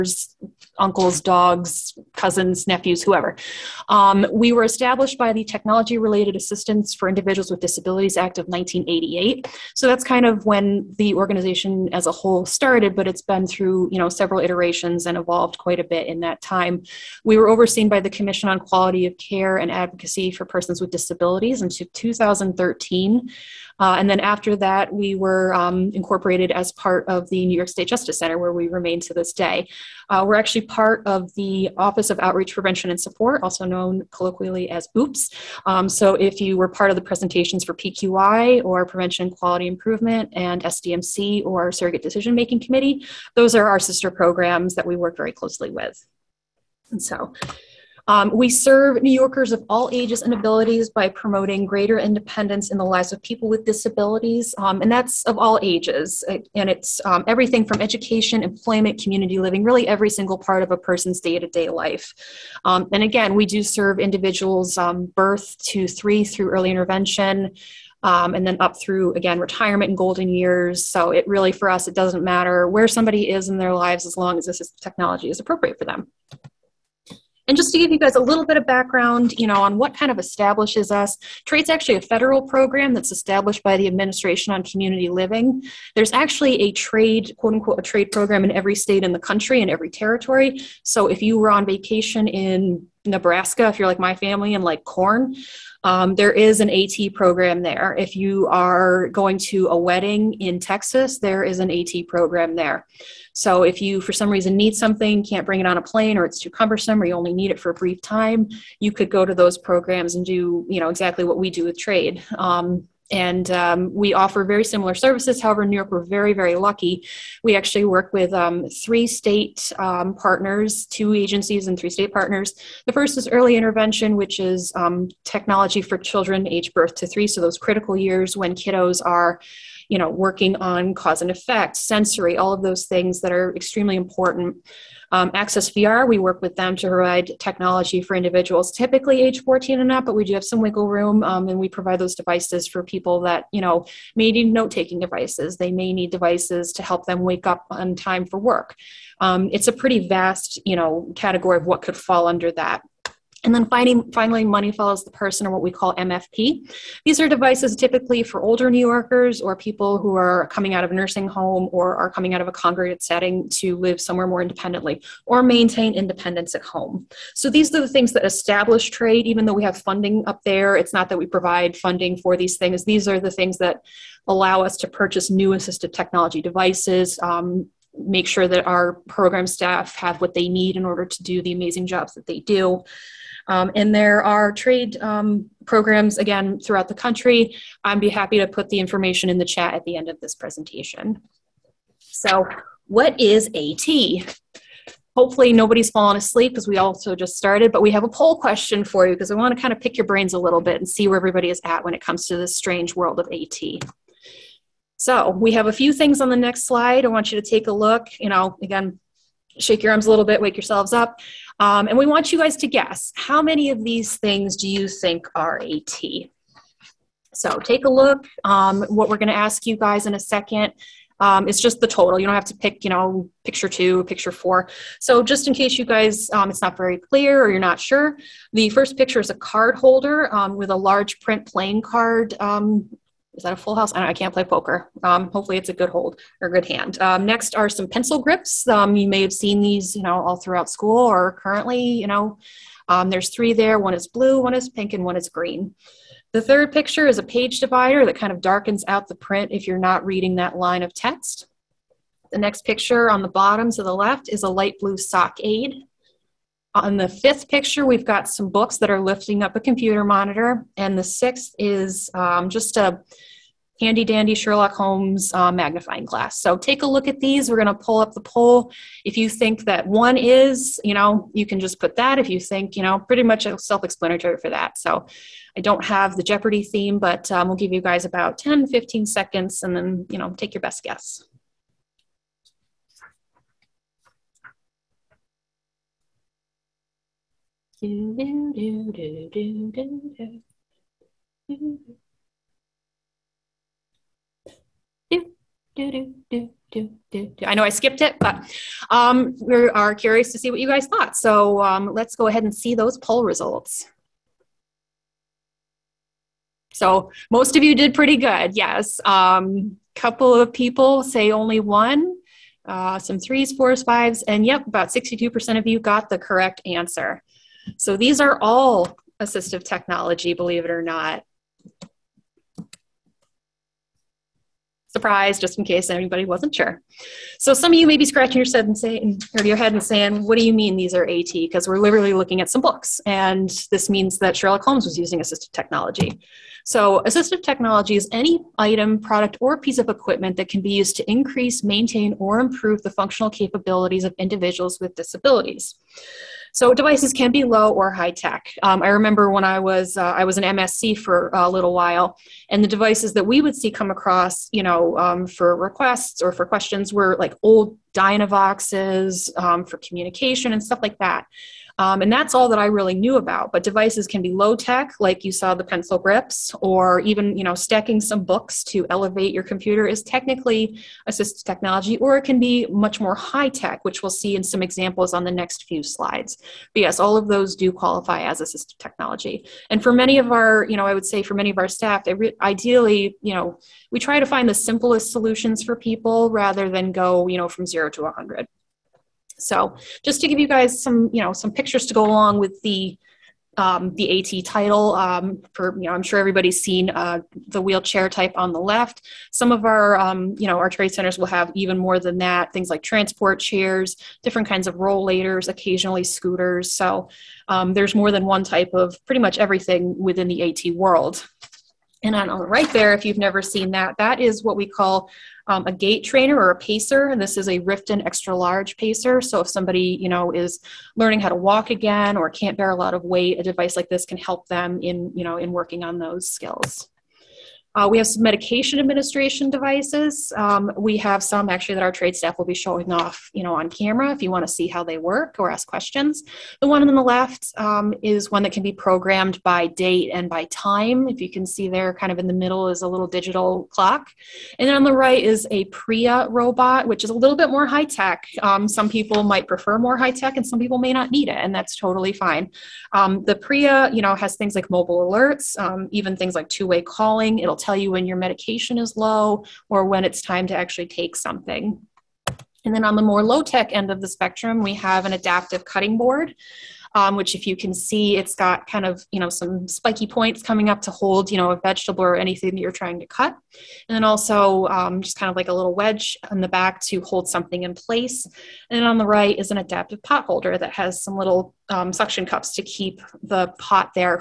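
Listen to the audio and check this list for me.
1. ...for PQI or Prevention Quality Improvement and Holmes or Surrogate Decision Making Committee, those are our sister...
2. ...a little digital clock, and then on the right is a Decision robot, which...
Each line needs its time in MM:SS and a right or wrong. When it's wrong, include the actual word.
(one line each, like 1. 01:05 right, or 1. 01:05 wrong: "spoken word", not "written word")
1. 00:37 wrong: "SDMC", not "Holmes"
2. 07:22 wrong: "Pria", not "Decision".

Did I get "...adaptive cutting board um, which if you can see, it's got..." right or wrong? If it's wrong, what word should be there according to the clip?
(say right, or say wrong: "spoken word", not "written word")
right.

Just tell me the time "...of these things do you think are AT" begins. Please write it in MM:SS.
03:33.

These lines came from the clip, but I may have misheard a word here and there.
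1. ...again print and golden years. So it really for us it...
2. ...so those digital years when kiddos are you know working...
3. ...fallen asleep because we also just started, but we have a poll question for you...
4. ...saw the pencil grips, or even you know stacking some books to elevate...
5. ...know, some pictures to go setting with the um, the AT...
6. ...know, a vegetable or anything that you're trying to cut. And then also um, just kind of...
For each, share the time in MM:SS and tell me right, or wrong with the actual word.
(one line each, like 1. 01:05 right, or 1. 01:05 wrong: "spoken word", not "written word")
1. 01:09 wrong: "retirement", not "print"
2. 02:07 wrong: "critical", not "digital"
3. 03:15 right
4. 06:05 right
5. 06:31 wrong: "along", not "setting"
6. 07:51 right.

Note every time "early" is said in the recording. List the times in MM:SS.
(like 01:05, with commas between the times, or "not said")
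01:06, 02:03.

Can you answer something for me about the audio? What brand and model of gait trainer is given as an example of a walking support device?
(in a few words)
Rifton extra large pacer.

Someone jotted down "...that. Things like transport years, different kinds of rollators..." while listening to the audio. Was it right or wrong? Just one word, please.
wrong.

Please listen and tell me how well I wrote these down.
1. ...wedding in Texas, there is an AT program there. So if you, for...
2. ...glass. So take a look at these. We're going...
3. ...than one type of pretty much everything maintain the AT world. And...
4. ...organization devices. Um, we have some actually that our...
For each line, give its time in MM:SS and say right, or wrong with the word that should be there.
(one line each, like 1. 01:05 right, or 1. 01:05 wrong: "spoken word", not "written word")
1. 01:39 right
2. 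04:26 right
3. 06:48 wrong: "within", not "maintain"
4. 07:08 wrong: "administration", not "organization".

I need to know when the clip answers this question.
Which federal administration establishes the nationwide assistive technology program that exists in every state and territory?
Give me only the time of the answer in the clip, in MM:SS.
01:23.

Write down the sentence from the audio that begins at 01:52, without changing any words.
Um, and um, we offer very similar services.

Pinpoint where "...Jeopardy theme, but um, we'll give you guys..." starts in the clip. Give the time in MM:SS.
04:36.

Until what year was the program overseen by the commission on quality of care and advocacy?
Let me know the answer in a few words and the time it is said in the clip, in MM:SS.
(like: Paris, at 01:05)
2013, at 00:21.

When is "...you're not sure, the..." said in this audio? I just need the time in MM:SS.
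03:47.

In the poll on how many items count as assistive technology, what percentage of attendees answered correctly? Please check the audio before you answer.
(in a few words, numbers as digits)
62%.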